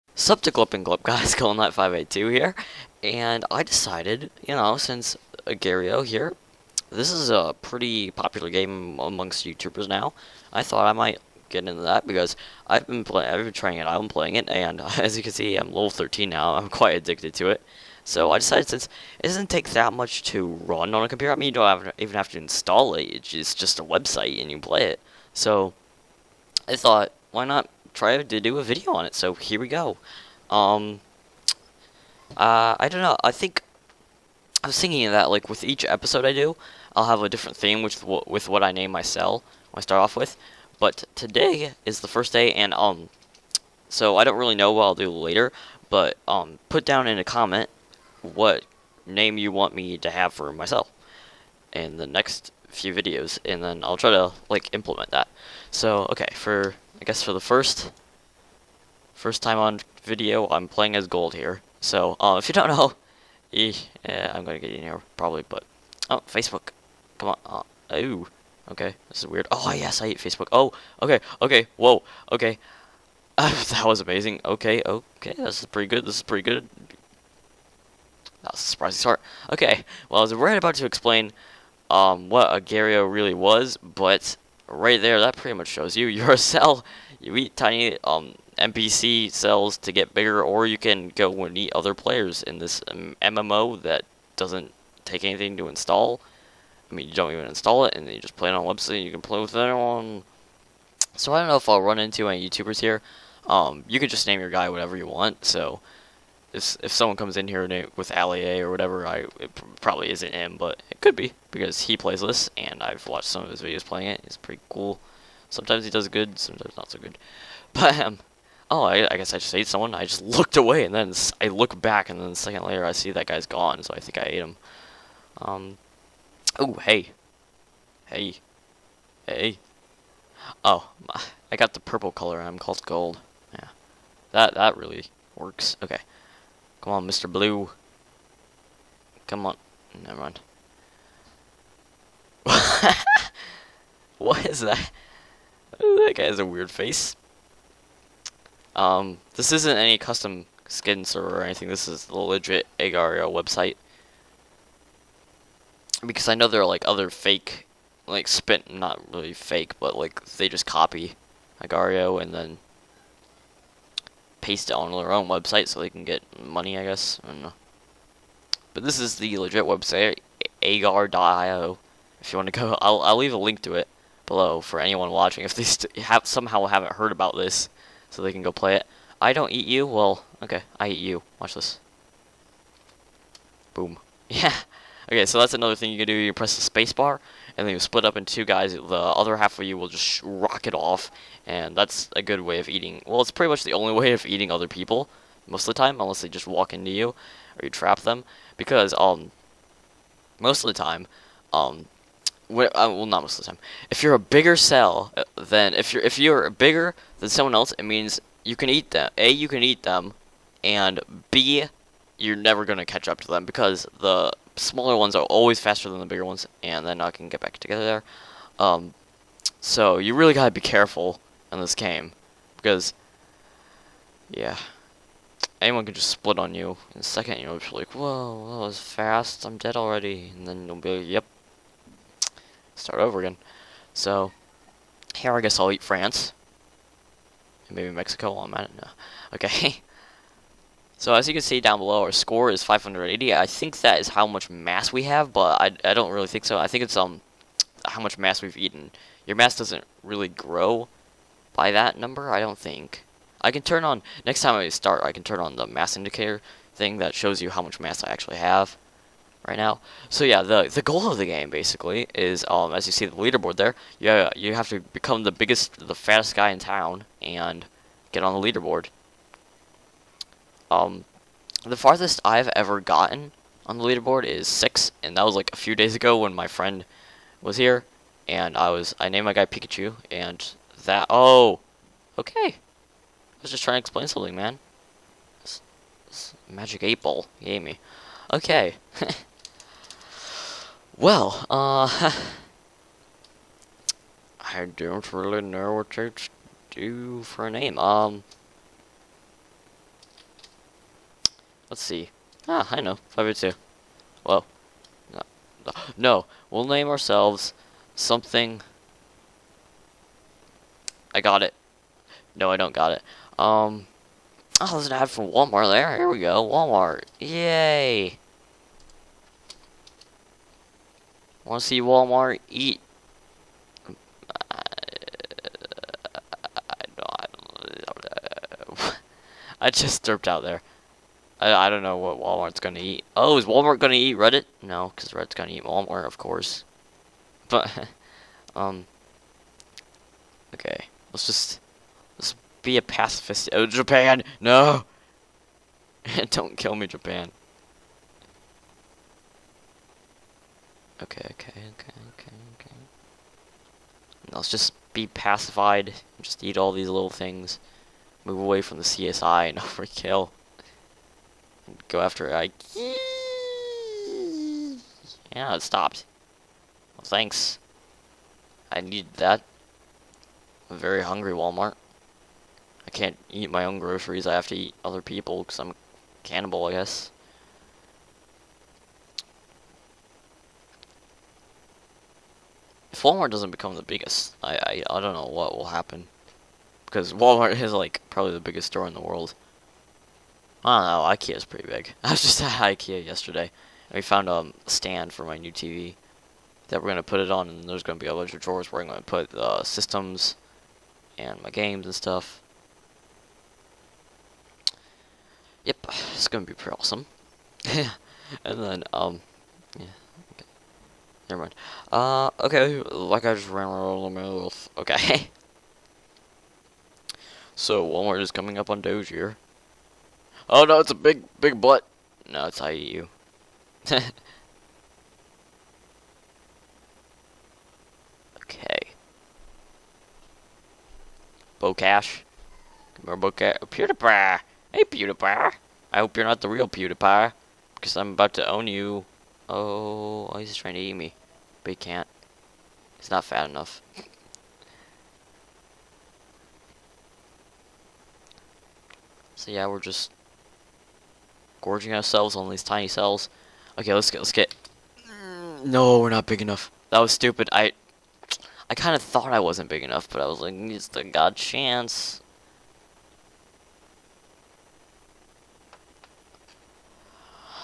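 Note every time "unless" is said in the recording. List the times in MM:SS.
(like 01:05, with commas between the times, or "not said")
03:15.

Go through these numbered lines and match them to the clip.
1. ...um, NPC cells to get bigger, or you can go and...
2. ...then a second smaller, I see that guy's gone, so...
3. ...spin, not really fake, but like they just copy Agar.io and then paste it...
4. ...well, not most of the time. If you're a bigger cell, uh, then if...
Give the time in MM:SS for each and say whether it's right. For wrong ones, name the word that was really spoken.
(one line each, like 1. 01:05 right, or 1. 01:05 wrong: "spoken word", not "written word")
1. 01:28 right
2. 02:02 wrong: "later", not "smaller"
3. 02:38 right
4. 03:22 right.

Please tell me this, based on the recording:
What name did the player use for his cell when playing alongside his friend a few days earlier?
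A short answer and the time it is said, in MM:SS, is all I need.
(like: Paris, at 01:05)
Pikachu, at 04:39.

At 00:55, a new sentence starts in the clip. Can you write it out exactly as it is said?
So, okay, for I guess for the first first time on video, I'm playing as gold here.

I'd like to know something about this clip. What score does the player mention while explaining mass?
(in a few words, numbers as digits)
580.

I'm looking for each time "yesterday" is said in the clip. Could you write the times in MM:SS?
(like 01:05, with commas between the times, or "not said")
06:33.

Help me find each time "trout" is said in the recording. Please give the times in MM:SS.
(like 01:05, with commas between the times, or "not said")
not said.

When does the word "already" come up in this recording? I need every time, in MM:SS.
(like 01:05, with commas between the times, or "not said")
03:49.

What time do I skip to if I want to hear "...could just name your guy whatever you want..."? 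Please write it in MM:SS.
01:43.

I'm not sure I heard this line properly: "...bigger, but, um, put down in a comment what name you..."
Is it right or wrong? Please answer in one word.
wrong.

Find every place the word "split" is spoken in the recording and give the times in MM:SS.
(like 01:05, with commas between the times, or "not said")
03:07, 03:46.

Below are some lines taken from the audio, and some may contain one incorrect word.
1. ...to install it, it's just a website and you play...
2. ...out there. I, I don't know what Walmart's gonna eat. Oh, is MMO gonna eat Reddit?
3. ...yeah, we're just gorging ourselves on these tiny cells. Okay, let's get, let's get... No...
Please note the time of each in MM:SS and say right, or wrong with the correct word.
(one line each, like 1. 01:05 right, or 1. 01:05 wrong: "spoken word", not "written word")
1. 00:22 right
2. 05:30 wrong: "Walmart", not "MMO"
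3. 07:29 right.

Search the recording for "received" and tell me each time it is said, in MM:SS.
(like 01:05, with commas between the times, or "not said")
not said.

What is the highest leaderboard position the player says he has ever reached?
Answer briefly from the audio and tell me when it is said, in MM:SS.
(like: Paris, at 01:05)
6, at 04:34.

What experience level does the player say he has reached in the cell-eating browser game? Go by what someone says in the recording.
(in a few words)
13.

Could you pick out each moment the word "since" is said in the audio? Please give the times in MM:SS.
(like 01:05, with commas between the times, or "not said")
00:04, 00:18.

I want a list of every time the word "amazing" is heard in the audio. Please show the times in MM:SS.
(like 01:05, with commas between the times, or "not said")
01:14.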